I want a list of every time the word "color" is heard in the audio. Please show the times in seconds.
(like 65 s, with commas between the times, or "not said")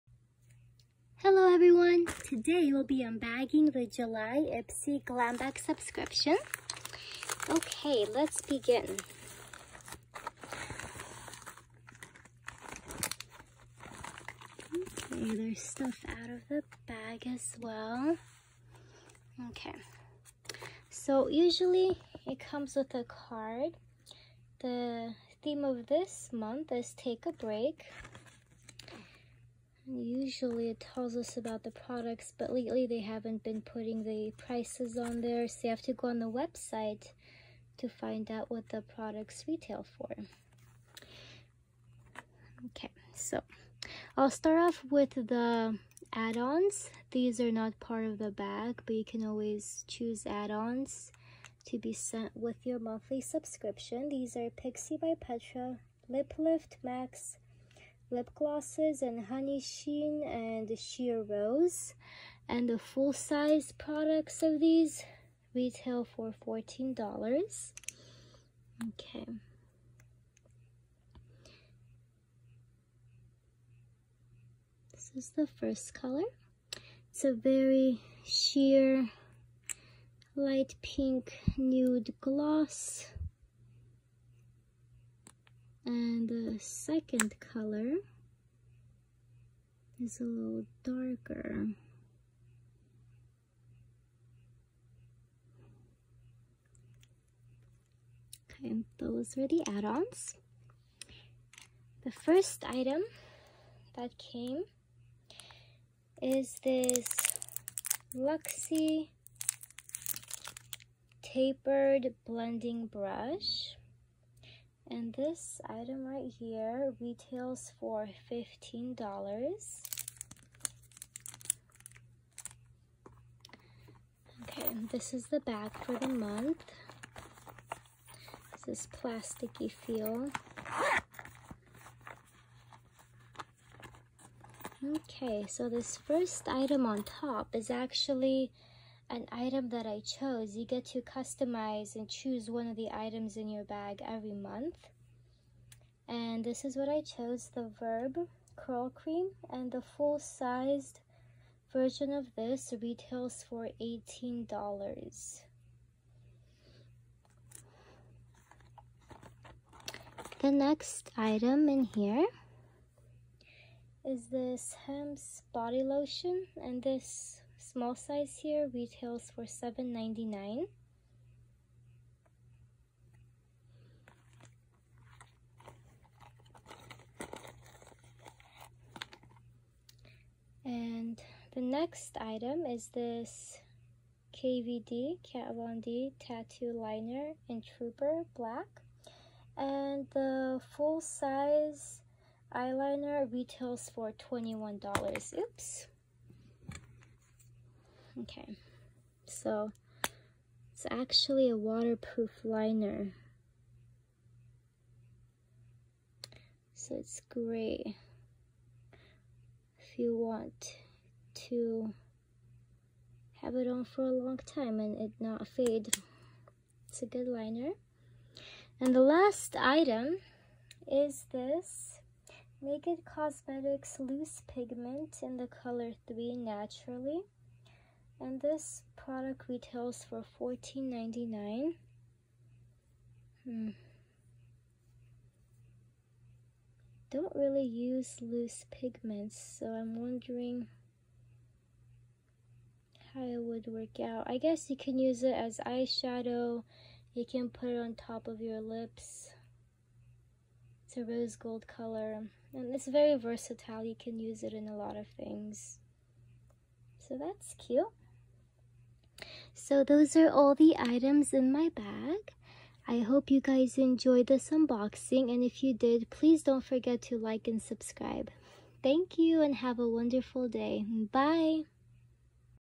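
75 s, 87 s, 225 s, 251 s.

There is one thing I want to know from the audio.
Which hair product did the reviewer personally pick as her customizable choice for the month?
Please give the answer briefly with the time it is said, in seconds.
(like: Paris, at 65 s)
Verb Curl Cream, at 147 s.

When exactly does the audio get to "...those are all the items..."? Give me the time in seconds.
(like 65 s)
259 s.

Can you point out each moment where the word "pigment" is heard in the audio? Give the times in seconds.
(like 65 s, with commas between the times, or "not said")
224 s, 238 s.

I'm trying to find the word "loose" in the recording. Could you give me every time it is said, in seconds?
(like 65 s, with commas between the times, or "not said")
224 s, 238 s.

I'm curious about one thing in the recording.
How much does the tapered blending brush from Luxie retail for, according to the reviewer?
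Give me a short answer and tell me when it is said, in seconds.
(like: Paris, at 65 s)
$15, at 118 s.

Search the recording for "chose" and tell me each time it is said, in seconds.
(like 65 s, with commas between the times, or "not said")
139 s, 147 s.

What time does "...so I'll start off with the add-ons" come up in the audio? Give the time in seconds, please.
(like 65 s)
43 s.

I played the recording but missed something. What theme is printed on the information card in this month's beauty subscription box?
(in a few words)
Take a break.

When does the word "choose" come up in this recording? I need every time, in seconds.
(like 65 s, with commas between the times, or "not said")
49 s, 142 s.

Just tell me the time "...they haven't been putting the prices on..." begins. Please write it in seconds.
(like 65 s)
32 s.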